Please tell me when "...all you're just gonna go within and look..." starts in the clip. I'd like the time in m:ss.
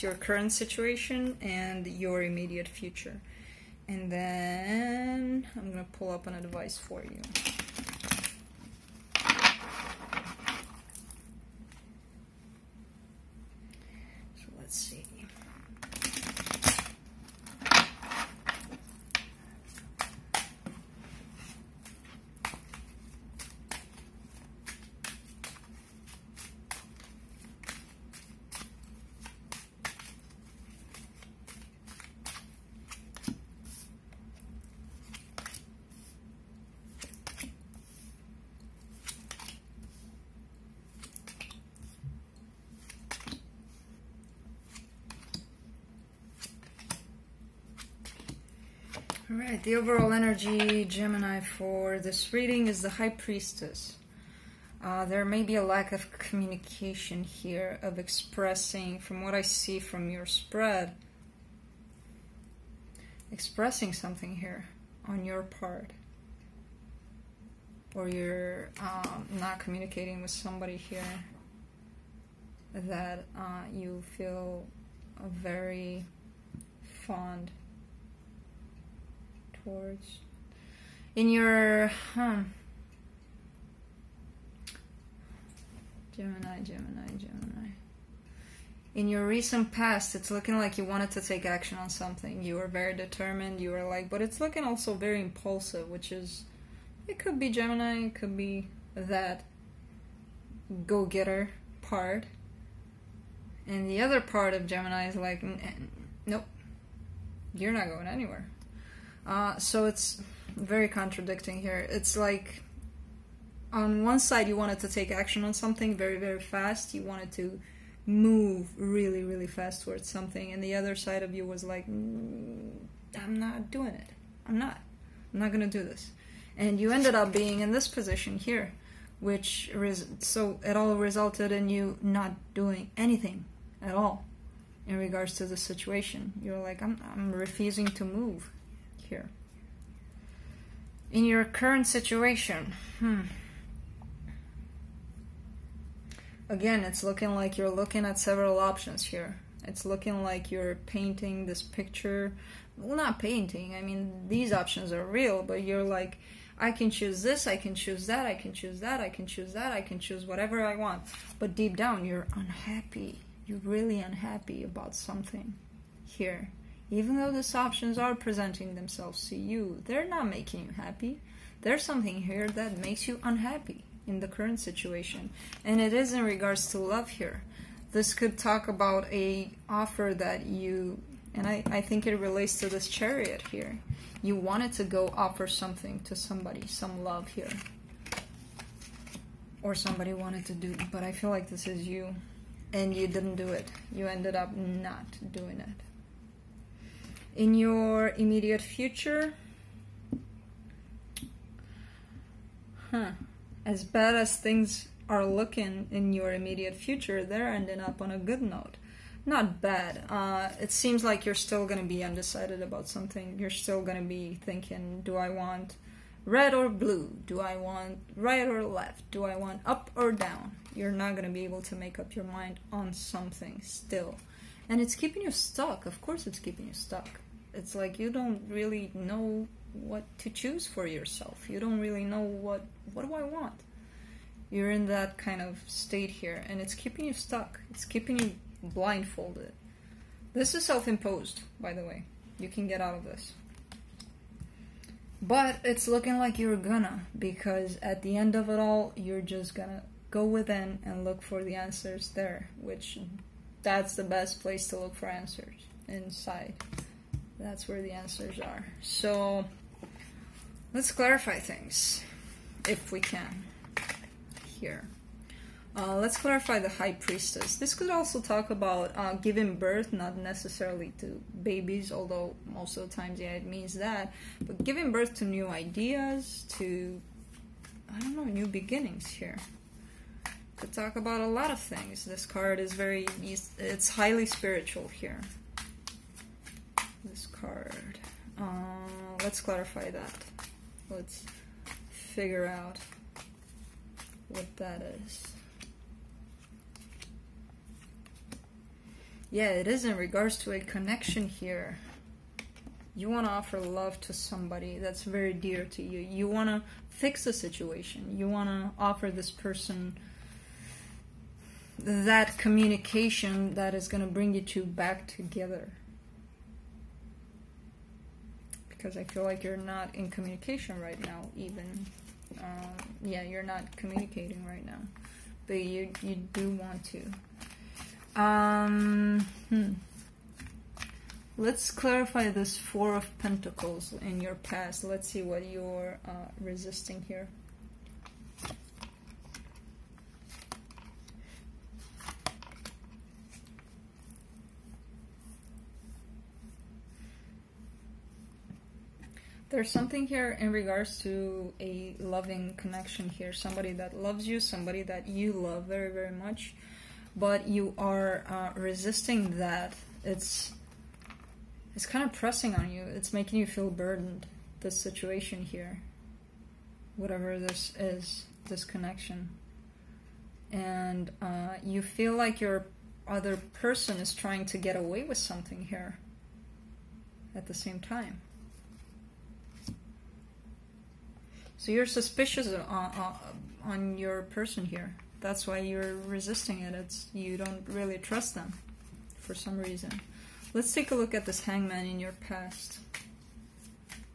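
4:08.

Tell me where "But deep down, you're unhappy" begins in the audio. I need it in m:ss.
2:41.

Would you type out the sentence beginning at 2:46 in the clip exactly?
Even though these options are presenting themselves to you, they're not making you happy.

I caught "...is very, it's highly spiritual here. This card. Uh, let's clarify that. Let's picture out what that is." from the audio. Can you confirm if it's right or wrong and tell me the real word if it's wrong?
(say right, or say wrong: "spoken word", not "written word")
wrong: "figure", not "picture".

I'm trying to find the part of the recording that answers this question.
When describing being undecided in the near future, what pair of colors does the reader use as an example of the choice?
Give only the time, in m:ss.
3:36.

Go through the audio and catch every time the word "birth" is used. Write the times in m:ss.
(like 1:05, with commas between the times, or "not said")
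4:29, 4:34.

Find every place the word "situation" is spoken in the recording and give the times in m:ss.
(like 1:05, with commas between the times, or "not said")
0:00, 2:15, 2:21, 2:54, 5:07, 6:04.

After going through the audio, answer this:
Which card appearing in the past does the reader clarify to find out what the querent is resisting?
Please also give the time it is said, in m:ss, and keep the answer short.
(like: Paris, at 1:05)
Four of Pentacles, at 5:32.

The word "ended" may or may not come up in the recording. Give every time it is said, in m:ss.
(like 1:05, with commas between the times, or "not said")
2:06, 3:14.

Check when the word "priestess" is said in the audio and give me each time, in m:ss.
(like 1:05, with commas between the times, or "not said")
0:53, 4:26.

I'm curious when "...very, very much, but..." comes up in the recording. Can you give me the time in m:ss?
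5:55.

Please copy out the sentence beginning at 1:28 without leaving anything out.
In your recent past, it's looking like you wanted to take action on something.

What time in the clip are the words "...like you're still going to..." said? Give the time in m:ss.
3:31.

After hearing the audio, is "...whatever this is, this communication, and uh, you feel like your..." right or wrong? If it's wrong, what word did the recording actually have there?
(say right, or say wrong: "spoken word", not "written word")
wrong: "connection", not "communication".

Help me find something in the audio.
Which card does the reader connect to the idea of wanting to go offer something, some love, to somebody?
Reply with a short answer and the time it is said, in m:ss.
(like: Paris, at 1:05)
Chariot, at 3:02.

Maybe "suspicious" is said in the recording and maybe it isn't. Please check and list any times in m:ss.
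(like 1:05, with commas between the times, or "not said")
6:21.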